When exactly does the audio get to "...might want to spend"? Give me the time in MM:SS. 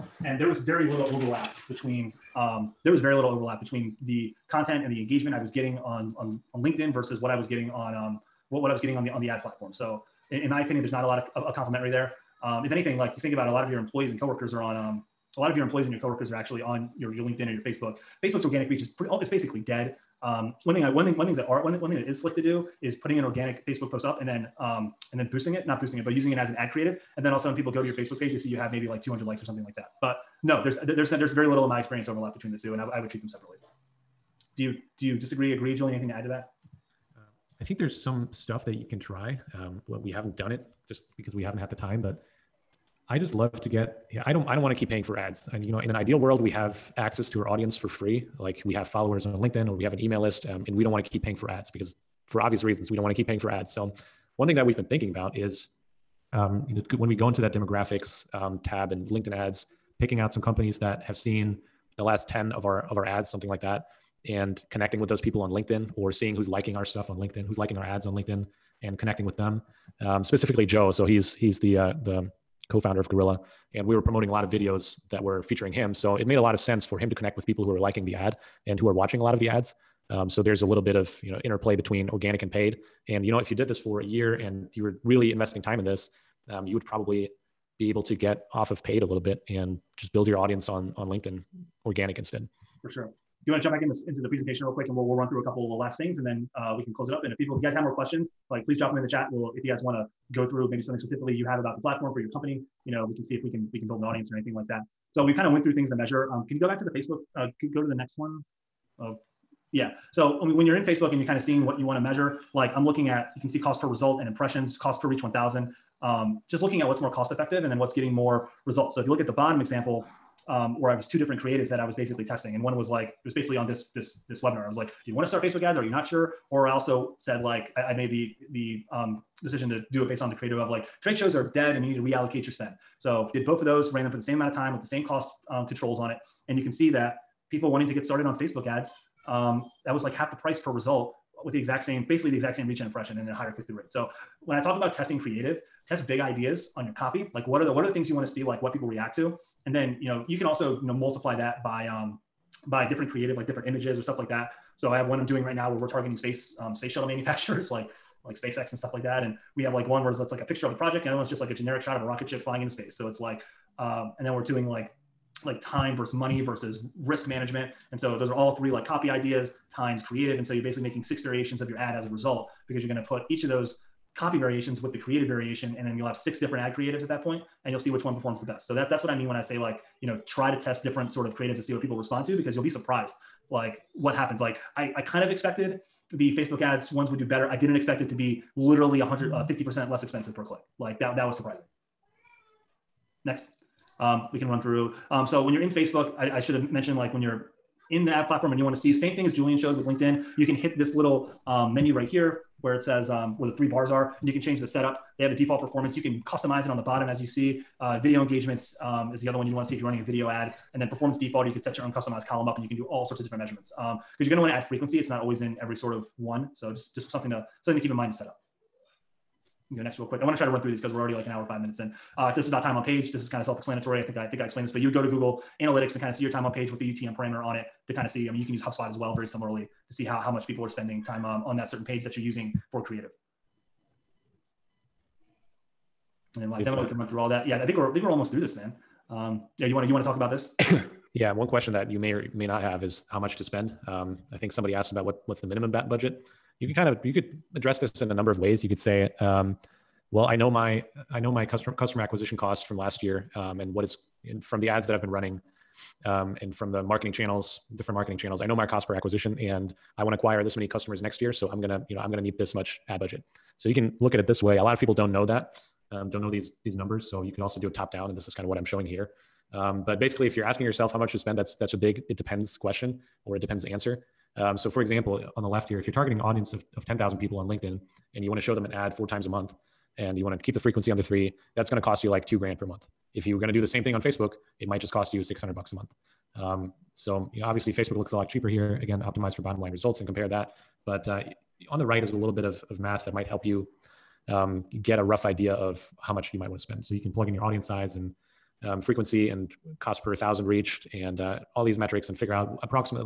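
04:56.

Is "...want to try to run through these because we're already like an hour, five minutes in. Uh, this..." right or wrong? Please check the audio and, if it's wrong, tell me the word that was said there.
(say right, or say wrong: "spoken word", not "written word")
right.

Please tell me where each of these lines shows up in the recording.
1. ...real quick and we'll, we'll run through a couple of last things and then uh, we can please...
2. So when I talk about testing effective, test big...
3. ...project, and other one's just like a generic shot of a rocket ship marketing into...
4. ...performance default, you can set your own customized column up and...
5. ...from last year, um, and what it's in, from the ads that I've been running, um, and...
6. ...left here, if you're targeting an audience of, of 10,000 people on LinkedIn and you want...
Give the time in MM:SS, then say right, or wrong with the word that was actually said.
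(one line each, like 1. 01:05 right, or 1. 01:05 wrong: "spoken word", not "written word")
1. 01:34 wrong: "close", not "please"
2. 02:23 wrong: "creative", not "effective"
3. 02:40 wrong: "flying", not "marketing"
4. 03:30 right
5. 04:12 right
6. 04:35 right.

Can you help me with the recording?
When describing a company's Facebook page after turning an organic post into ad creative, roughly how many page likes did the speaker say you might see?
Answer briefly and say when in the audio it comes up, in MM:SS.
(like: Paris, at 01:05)
200, at 00:29.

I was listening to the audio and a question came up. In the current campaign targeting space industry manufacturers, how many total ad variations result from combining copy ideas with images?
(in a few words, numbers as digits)
6.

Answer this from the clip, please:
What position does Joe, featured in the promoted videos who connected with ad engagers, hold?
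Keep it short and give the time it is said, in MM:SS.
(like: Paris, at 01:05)
Co-founder, at 01:12.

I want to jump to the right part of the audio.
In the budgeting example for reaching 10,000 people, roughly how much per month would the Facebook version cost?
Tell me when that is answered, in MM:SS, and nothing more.
04:45.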